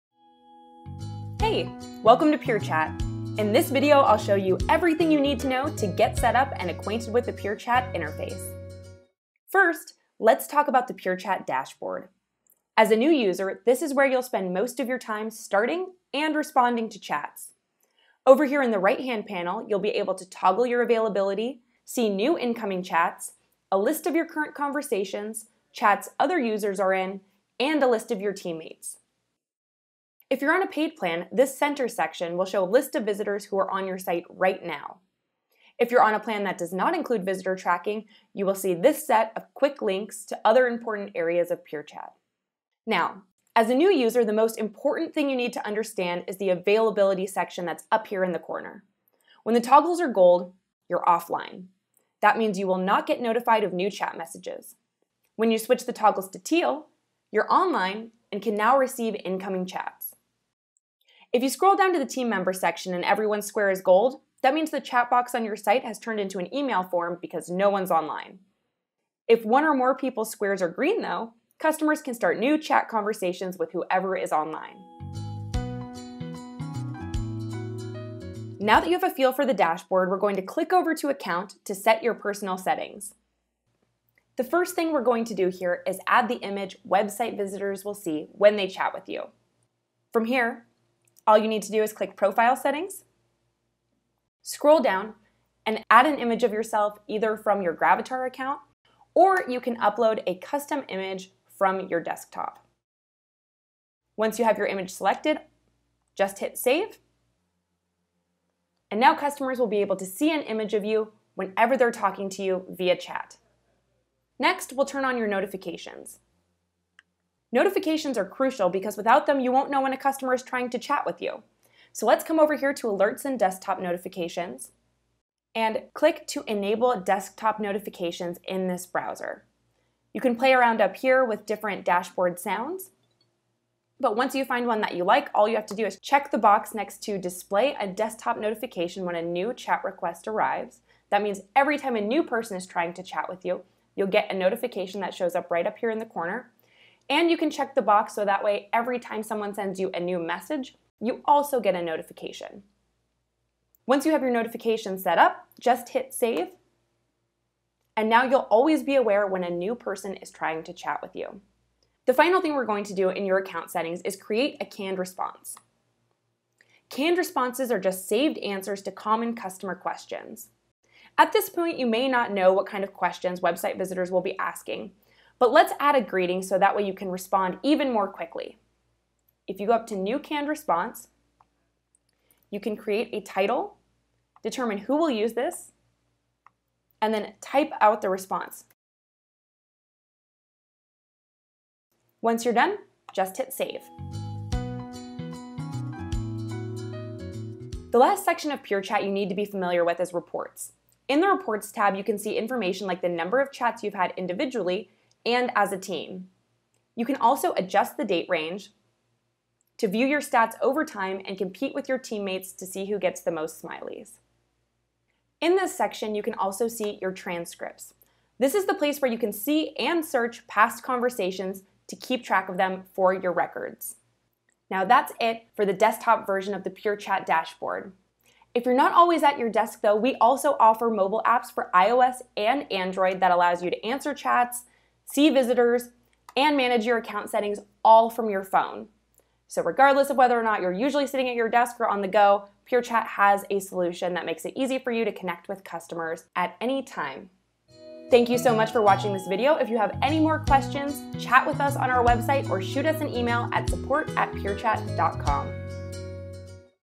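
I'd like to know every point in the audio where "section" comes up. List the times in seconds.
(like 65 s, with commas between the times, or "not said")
31 s, 47 s, 62 s, 198 s, 215 s.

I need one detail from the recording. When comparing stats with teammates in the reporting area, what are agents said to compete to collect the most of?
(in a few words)
Smileys.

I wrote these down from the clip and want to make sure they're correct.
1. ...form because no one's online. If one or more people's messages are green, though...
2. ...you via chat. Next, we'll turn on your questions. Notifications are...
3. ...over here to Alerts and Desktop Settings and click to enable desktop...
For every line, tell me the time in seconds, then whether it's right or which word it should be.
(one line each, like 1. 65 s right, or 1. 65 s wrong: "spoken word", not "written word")
1. 66 s wrong: "squares", not "messages"
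2. 112 s wrong: "notifications", not "questions"
3. 122 s wrong: "Notifications", not "Settings".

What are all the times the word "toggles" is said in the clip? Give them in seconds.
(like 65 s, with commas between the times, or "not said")
20 s, 49 s, 55 s.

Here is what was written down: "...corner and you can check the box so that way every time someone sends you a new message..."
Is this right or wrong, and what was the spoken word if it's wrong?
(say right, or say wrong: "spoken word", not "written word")
right.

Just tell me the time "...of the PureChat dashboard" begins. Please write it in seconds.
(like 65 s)
226 s.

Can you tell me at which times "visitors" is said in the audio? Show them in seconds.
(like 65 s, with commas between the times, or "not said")
33 s, 37 s, 87 s, 173 s, 235 s.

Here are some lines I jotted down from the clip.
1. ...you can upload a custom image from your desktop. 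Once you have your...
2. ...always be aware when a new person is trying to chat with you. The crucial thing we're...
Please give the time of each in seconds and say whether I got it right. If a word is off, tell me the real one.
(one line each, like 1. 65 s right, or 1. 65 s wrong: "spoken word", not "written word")
1. 99 s right
2. 158 s wrong: "final", not "crucial".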